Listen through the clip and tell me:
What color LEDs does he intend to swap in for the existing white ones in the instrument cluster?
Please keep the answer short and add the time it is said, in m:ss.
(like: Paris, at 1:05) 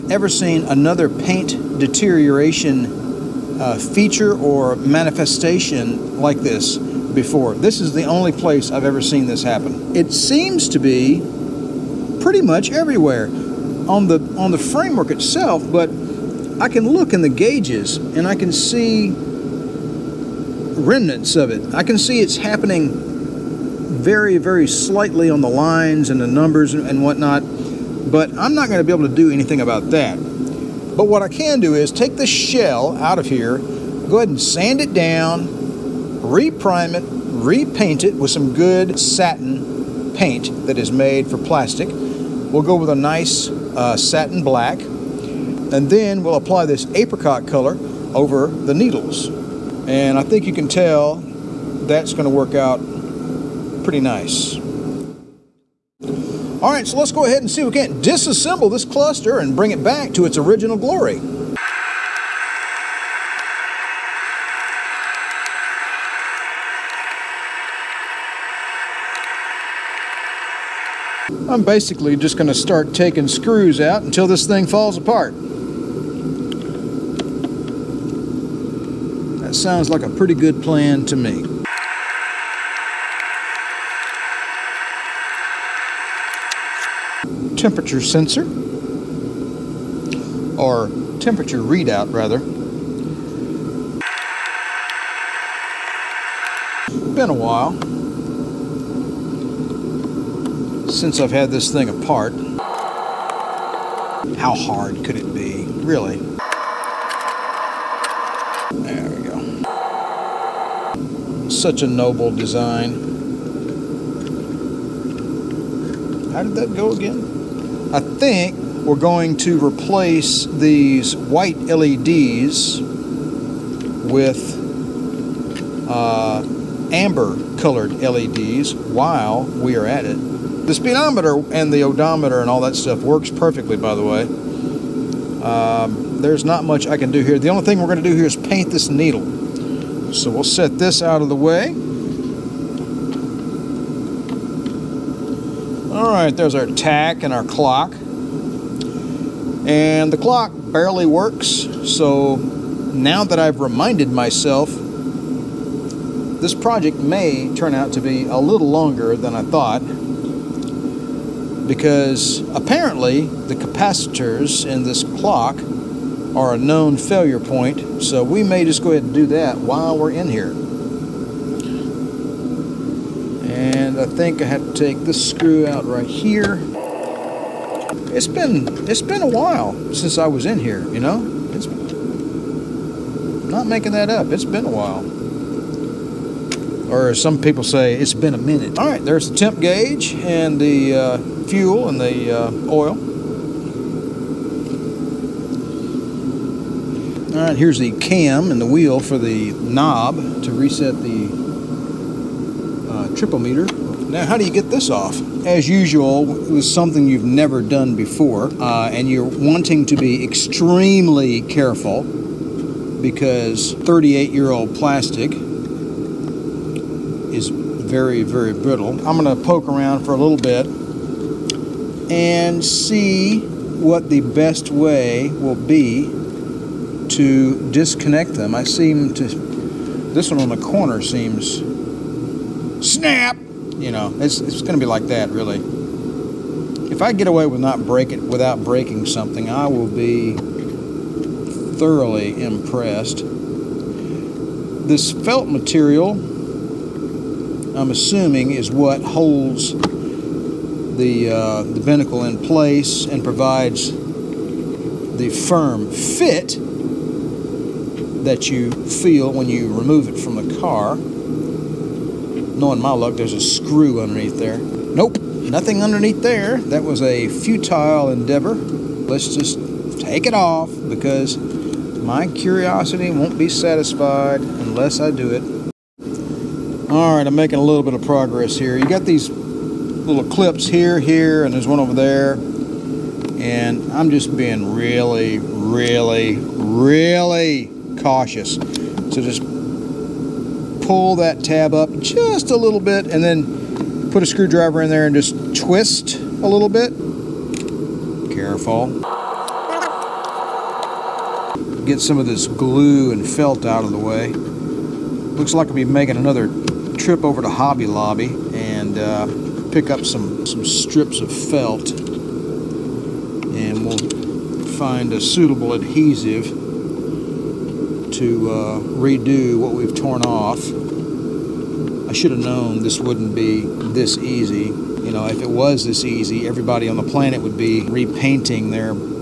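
amber, at 2:06.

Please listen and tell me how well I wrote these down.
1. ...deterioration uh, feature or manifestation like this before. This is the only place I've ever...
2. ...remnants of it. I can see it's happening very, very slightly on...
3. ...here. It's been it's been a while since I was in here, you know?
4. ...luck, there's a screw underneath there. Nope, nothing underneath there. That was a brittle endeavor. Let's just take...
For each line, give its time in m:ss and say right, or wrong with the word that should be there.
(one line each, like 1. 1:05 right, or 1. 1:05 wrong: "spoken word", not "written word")
1. 0:01 right
2. 0:20 right
3. 2:56 right
4. 4:22 wrong: "futile", not "brittle".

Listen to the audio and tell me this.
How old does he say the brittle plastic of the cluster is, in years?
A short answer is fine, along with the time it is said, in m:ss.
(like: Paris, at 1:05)
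38, at 3:33.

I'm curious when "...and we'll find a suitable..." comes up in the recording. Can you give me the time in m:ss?
5:11.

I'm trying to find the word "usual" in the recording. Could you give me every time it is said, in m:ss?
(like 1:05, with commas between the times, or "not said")
3:25.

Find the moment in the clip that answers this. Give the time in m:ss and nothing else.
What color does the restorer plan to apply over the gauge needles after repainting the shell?
0:46.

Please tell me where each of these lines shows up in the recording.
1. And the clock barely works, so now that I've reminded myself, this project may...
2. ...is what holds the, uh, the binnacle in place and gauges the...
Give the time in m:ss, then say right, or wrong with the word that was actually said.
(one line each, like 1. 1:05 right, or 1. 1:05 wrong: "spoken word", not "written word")
1. 2:29 right
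2. 4:08 wrong: "provides", not "gauges".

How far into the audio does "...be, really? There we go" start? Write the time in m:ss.
1:45.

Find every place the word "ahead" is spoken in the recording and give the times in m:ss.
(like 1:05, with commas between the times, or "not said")
0:34, 0:57, 2:48.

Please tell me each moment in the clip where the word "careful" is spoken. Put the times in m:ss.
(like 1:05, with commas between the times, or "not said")
3:31, 4:58.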